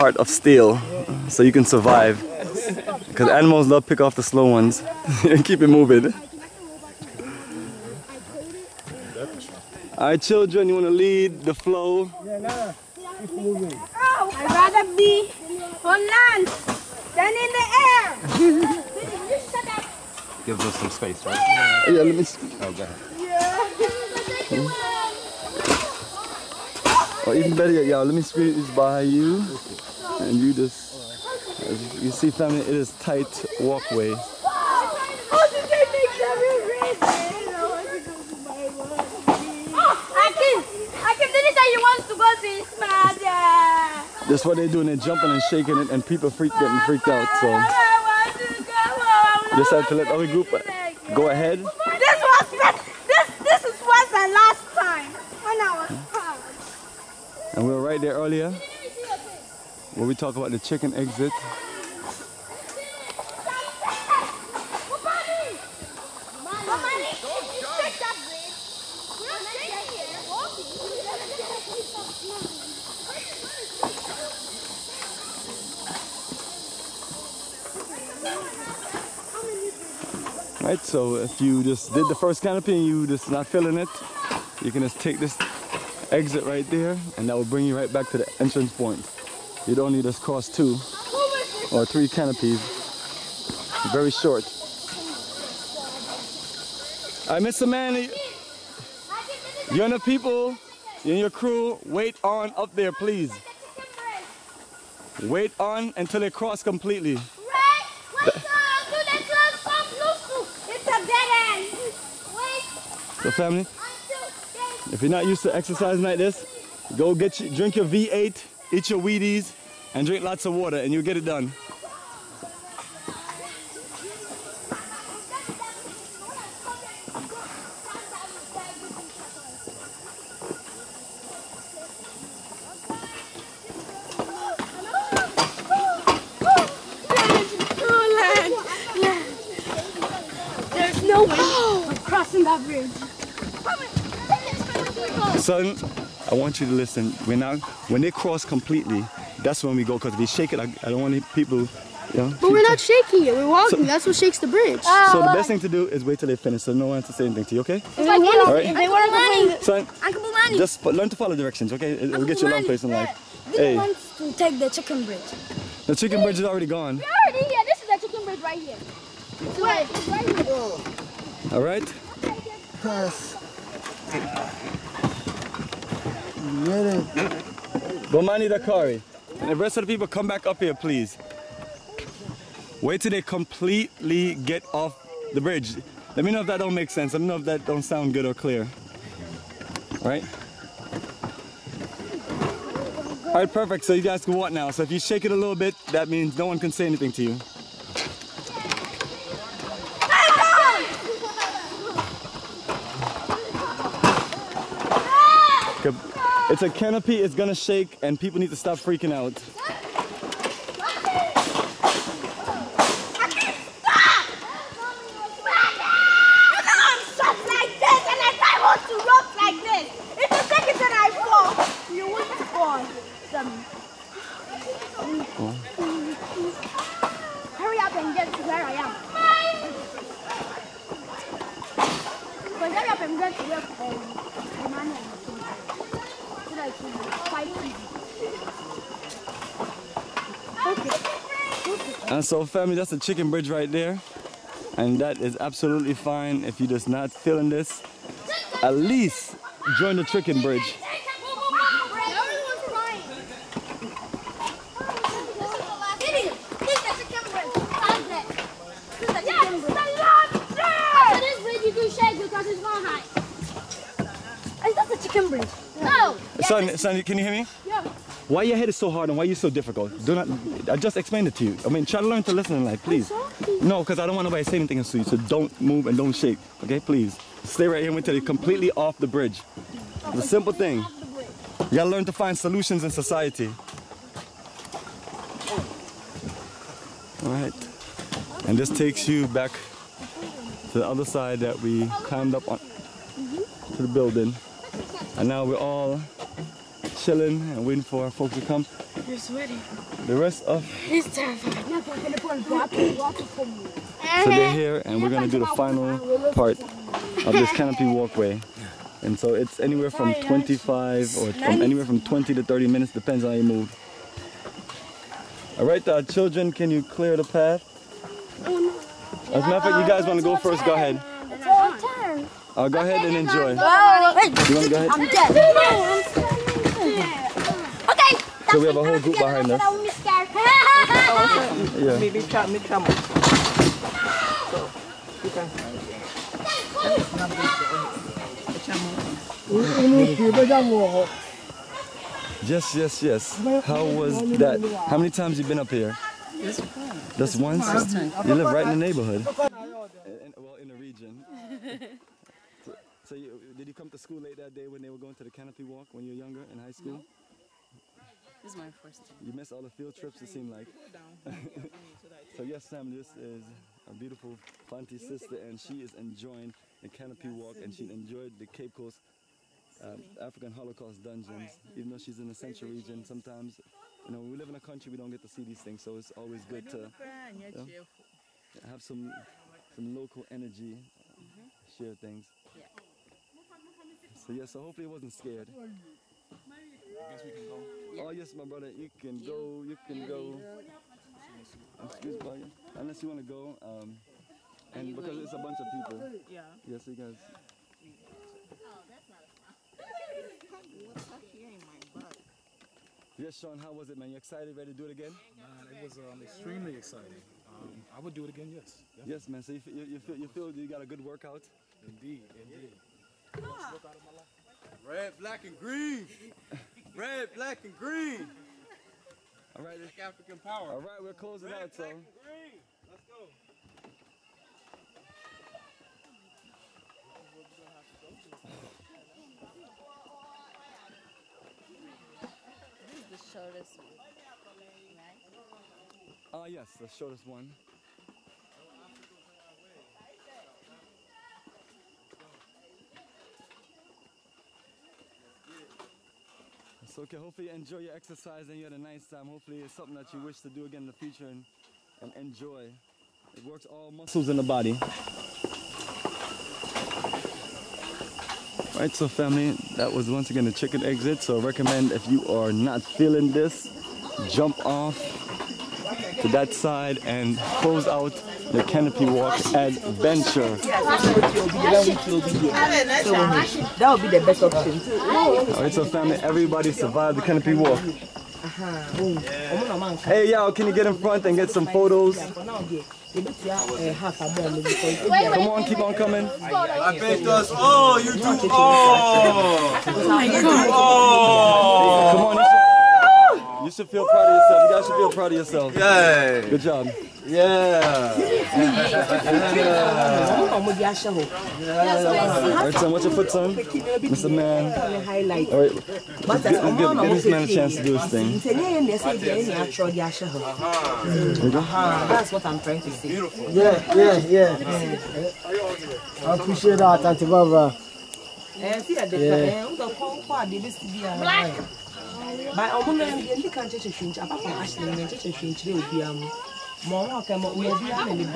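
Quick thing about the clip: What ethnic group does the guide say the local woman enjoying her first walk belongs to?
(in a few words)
Fanti.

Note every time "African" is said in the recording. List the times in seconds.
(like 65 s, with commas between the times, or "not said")
370 s, 419 s.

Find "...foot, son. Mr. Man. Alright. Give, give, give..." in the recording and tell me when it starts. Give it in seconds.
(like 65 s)
503 s.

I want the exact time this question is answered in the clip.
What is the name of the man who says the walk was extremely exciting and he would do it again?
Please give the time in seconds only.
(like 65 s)
403 s.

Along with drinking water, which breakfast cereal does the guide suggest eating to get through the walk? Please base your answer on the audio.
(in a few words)
Wheaties.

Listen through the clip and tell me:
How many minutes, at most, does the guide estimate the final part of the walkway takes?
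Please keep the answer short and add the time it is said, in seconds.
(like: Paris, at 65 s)
30, at 312 s.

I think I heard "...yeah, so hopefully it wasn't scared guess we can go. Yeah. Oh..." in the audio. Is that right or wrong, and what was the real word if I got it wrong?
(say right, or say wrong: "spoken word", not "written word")
right.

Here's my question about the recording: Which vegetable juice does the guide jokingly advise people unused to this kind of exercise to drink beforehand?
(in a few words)
V8.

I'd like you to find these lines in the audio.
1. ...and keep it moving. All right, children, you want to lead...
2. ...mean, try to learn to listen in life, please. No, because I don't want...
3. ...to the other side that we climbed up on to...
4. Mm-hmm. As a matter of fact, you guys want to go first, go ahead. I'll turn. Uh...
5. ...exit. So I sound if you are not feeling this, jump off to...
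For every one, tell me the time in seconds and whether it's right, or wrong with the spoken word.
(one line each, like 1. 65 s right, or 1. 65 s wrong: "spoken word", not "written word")
1. 5 s right
2. 271 s right
3. 290 s right
4. 318 s right
5. 460 s wrong: "recommend", not "sound".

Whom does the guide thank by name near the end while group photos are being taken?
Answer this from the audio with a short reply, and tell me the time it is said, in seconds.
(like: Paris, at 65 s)
Auntie Barbara, at 517 s.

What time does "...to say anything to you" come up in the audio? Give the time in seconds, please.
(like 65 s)
157 s.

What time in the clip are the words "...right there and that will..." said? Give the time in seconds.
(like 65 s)
86 s.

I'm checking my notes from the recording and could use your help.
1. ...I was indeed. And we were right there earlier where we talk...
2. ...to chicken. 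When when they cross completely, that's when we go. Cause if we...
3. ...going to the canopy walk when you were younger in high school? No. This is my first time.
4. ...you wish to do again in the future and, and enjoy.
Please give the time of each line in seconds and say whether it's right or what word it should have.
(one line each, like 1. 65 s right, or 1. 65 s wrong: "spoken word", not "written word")
1. 55 s wrong: "tired", not "indeed"
2. 146 s wrong: "listen", not "chicken"
3. 354 s right
4. 450 s right.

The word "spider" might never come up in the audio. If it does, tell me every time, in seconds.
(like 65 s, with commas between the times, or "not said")
not said.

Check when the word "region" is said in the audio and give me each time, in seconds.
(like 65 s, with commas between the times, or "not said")
350 s, 372 s.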